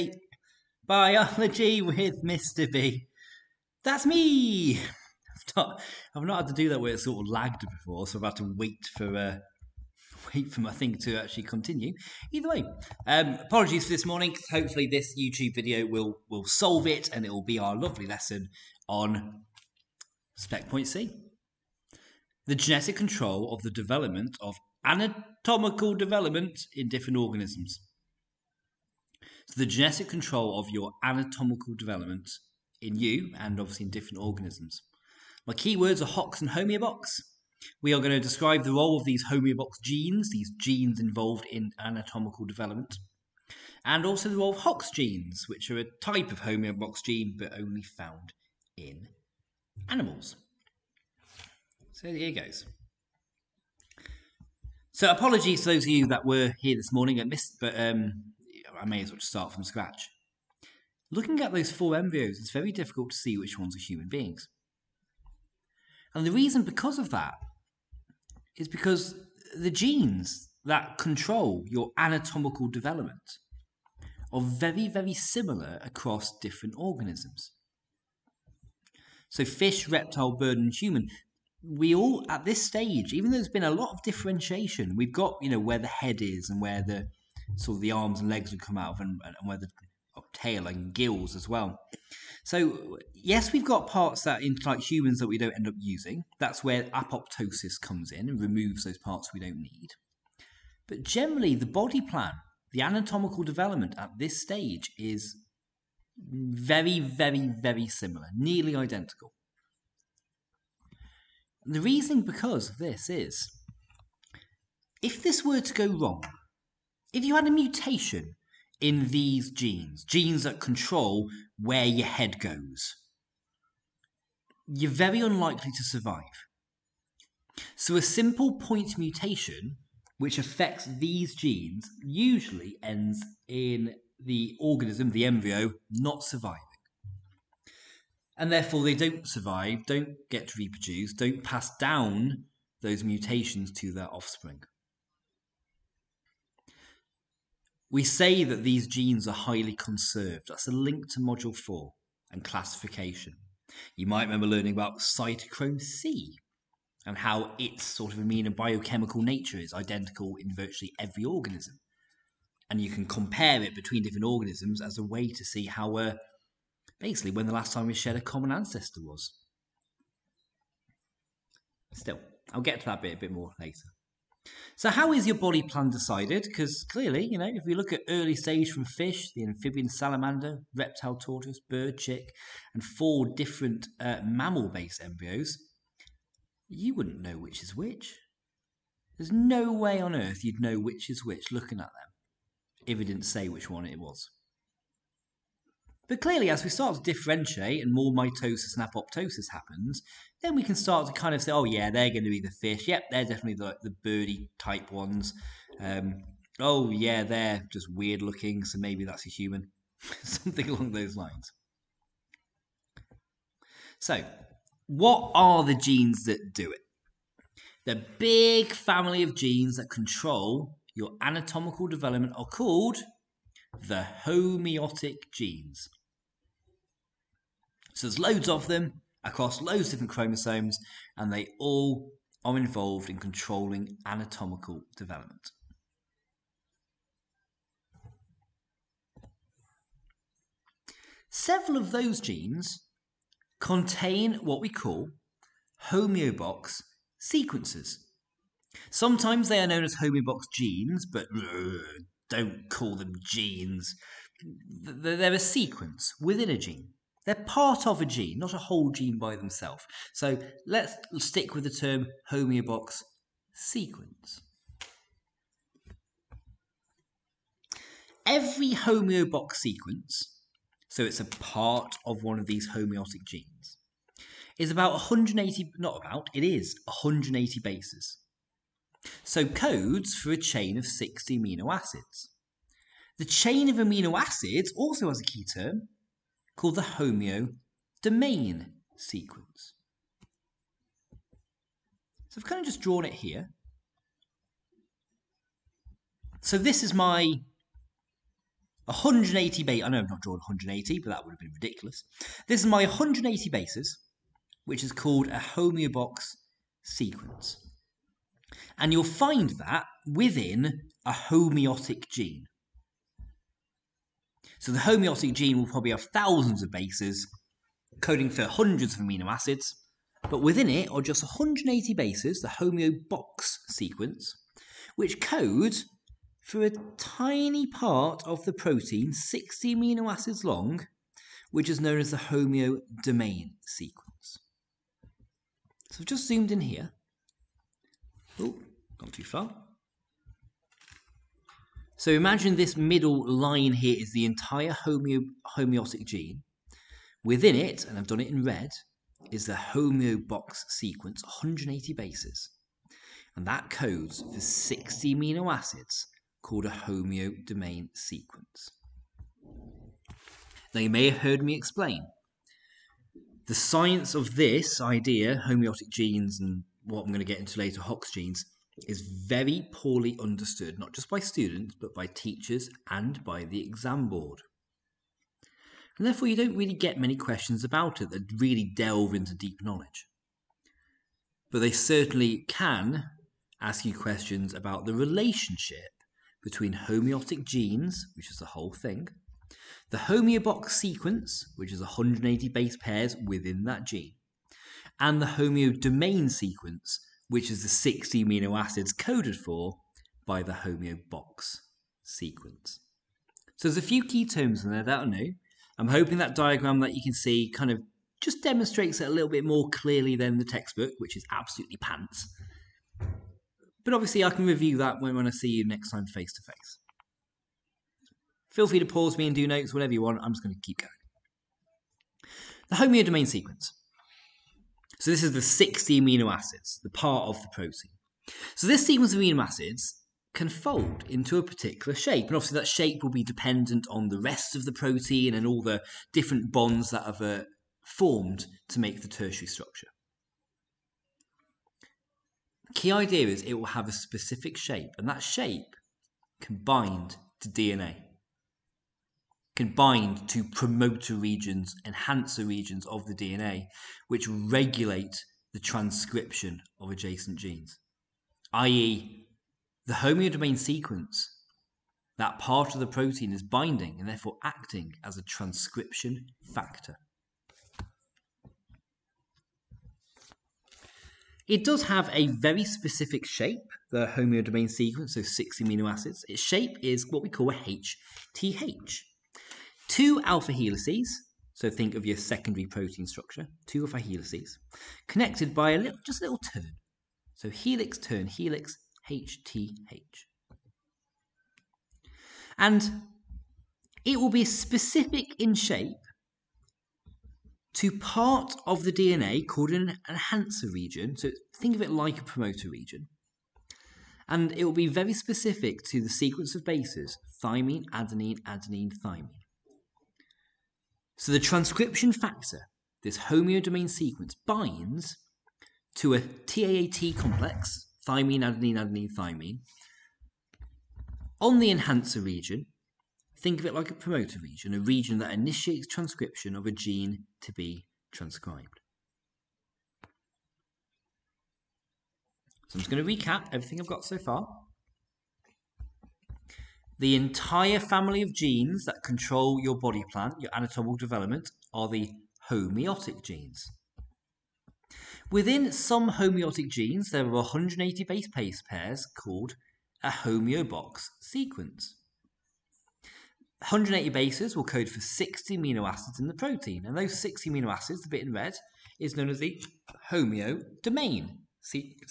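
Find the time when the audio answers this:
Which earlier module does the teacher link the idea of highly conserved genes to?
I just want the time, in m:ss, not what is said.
2:31.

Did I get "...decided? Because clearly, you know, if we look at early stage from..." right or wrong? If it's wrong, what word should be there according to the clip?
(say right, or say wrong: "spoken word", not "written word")
right.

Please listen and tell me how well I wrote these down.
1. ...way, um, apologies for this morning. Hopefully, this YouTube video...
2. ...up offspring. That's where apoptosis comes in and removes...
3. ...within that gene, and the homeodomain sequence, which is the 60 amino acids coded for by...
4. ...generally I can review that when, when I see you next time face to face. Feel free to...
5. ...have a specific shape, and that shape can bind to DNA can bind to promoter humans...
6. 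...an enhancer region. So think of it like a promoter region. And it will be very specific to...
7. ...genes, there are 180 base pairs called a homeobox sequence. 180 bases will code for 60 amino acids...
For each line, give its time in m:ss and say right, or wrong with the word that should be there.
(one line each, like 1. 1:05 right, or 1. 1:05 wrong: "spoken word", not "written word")
1. 0:12 right
2. 1:35 wrong: "using", not "offspring"
3. 6:33 right
4. 6:53 wrong: "obviously", not "generally"
5. 7:23 wrong: "regions", not "humans"
6. 8:19 right
7. 9:06 right.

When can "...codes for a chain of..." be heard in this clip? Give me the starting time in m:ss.
4:39.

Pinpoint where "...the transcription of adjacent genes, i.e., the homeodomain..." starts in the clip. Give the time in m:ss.
7:35.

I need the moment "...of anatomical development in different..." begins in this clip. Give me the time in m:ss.
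0:24.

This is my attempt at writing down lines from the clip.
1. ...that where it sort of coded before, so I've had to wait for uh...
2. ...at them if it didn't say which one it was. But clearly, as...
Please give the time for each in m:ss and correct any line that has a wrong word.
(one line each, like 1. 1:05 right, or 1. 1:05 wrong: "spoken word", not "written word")
1. 0:06 wrong: "lagged", not "coded"
2. 3:11 right.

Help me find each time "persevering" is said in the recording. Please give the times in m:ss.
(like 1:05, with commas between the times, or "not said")
not said.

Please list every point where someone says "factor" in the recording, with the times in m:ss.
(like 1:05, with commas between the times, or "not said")
7:46, 8:32.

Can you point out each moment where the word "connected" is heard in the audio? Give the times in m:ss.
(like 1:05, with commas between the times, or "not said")
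8:05.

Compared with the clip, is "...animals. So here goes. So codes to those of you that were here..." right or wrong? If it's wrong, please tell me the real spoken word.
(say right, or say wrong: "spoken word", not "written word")
wrong: "apologies", not "codes".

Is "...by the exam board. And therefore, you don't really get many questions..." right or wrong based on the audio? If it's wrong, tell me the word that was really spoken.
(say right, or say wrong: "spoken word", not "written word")
right.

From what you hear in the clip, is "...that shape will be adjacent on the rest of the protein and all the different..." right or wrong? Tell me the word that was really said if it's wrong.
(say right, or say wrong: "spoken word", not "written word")
wrong: "dependent", not "adjacent".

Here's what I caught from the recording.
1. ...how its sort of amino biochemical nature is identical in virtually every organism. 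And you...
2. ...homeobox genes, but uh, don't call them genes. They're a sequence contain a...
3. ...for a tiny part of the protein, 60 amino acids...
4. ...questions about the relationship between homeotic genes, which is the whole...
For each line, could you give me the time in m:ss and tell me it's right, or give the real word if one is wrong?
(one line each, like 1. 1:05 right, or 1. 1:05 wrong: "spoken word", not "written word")
1. 2:37 right
2. 4:09 wrong: "within", not "contain"
3. 5:26 right
4. 6:23 right.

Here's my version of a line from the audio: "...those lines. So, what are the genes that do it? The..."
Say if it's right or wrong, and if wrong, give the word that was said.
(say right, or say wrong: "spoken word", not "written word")
right.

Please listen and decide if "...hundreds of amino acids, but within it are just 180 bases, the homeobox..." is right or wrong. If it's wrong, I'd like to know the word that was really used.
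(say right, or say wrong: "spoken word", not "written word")
right.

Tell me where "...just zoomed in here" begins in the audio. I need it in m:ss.
5:36.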